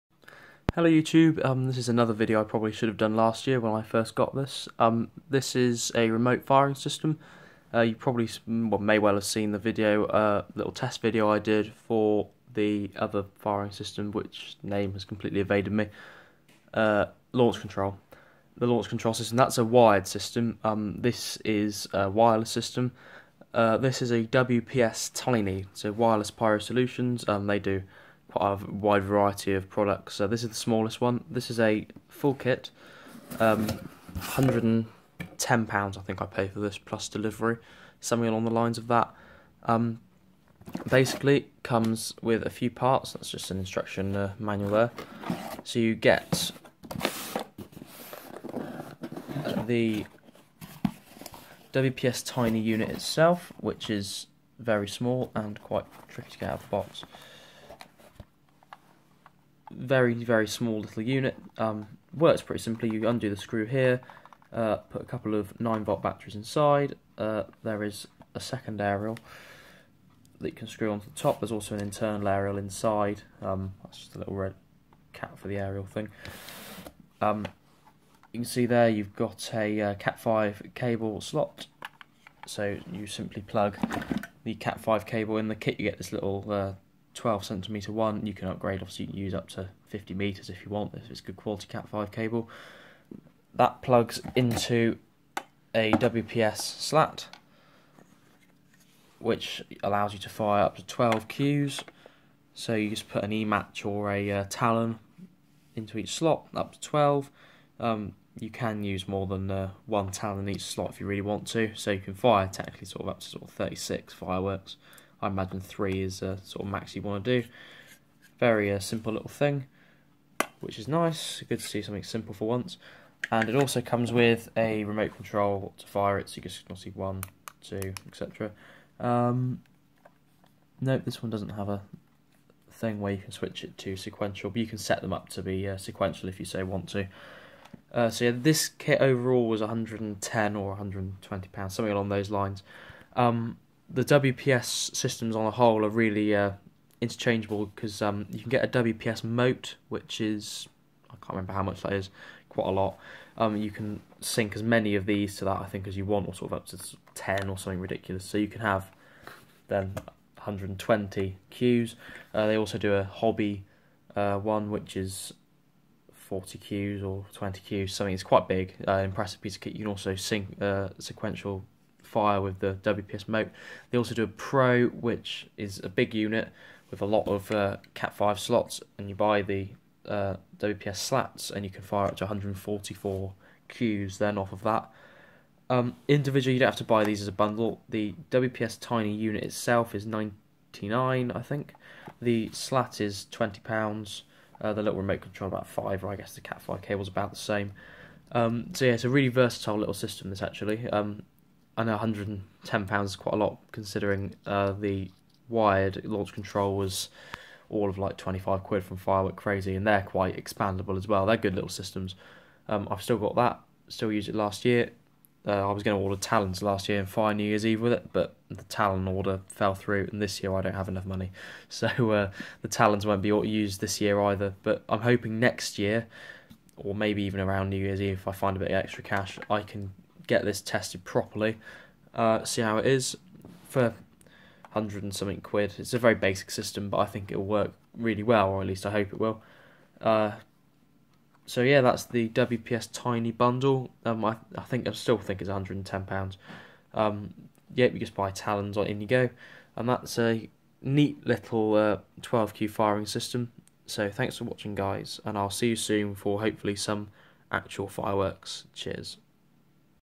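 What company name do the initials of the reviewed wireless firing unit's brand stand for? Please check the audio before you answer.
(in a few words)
Wireless Pyro Solutions.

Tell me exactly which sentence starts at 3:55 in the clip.
It's a very basic system, but I think it'll work really well, or at least I hope it will.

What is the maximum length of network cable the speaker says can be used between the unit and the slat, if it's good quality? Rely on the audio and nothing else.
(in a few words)
50 meters.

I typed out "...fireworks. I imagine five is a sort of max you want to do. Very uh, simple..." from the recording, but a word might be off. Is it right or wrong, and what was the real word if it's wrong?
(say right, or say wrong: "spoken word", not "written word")
wrong: "three", not "five".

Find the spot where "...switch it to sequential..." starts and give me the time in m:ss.
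2:13.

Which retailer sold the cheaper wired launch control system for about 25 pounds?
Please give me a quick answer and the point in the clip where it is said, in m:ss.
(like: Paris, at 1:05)
Firework Crazy, at 3:28.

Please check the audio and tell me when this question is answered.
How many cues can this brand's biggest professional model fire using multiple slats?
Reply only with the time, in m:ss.
3:02.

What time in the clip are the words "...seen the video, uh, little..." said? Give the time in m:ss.
0:09.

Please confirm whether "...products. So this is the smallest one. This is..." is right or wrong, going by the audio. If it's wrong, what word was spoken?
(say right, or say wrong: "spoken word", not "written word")
right.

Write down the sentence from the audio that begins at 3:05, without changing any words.
Um, individually, you don't have to buy these as a bundle.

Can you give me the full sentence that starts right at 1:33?
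That plugs into a WPS slat, which allows you to fire up to 12 Qs.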